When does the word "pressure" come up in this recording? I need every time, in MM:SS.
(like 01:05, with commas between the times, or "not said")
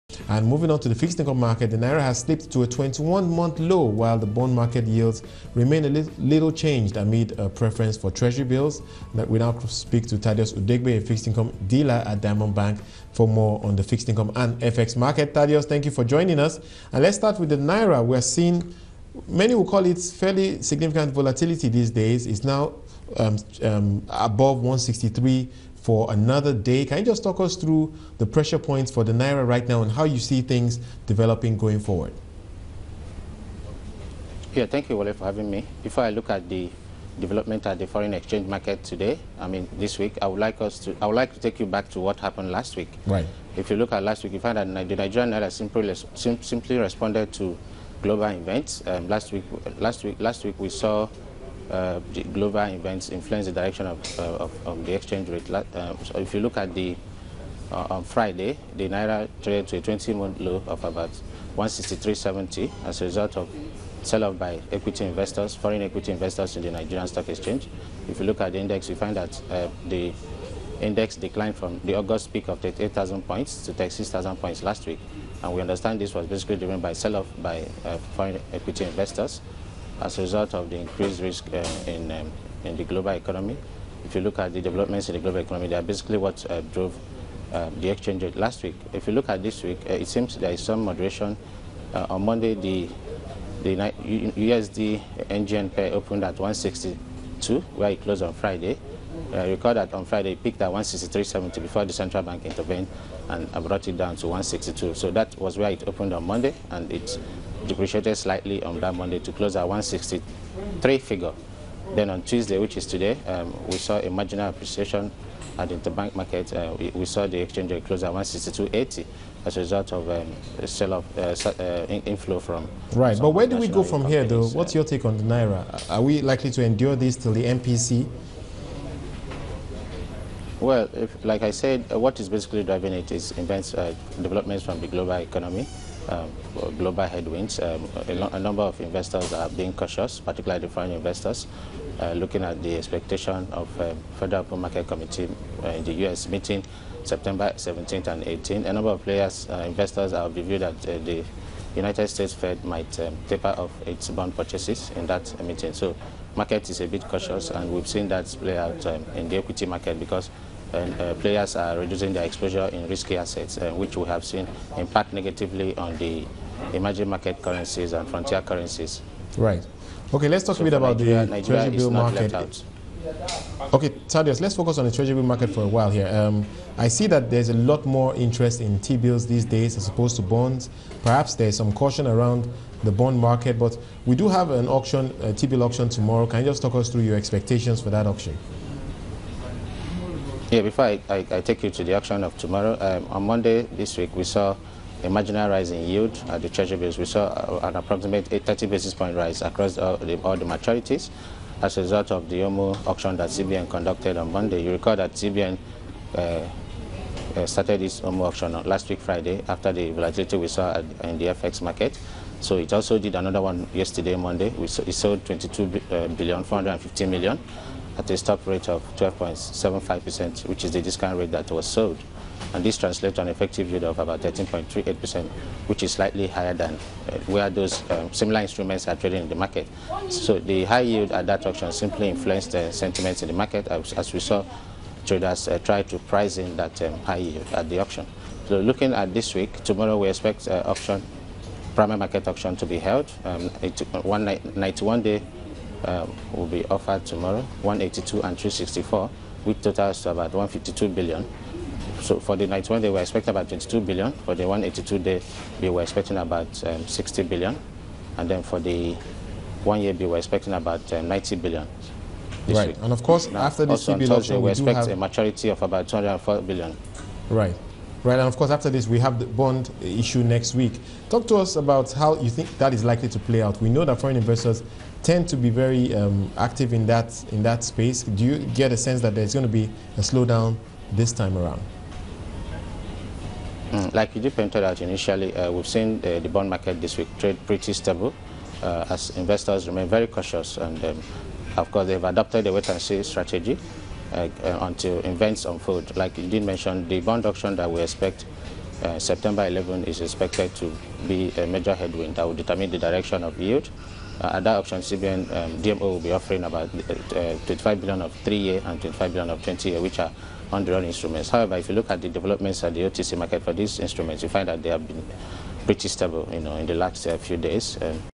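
00:28.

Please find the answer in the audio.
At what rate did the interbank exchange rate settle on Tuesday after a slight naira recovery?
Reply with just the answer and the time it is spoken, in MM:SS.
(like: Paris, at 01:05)
162.80, at 01:58.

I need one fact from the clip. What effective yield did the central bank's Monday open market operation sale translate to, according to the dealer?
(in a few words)
13.38%.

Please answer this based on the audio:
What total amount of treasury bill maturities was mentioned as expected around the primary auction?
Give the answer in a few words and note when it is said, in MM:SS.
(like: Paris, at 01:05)
204 billion, at 04:25.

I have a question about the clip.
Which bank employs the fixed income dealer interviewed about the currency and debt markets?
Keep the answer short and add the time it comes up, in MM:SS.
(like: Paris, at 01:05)
Diamond Bank, at 00:12.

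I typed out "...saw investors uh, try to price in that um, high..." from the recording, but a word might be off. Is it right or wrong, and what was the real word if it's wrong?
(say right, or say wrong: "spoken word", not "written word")
wrong: "traders", not "investors".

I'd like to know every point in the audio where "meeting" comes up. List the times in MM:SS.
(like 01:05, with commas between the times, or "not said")
02:26, 02:35.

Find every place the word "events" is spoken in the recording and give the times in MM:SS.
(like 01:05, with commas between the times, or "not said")
00:48, 00:52, 02:13, 04:54.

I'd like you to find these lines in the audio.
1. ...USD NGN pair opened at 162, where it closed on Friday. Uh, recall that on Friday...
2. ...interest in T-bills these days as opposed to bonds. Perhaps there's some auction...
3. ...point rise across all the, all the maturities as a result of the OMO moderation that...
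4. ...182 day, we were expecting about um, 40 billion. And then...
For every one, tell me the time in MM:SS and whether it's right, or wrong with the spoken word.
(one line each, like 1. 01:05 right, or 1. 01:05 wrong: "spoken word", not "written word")
1. 01:33 right
2. 02:58 wrong: "caution", not "auction"
3. 03:18 wrong: "auction", not "moderation"
4. 04:14 wrong: "60", not "40".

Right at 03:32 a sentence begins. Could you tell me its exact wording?
So it also did another one yesterday, Monday.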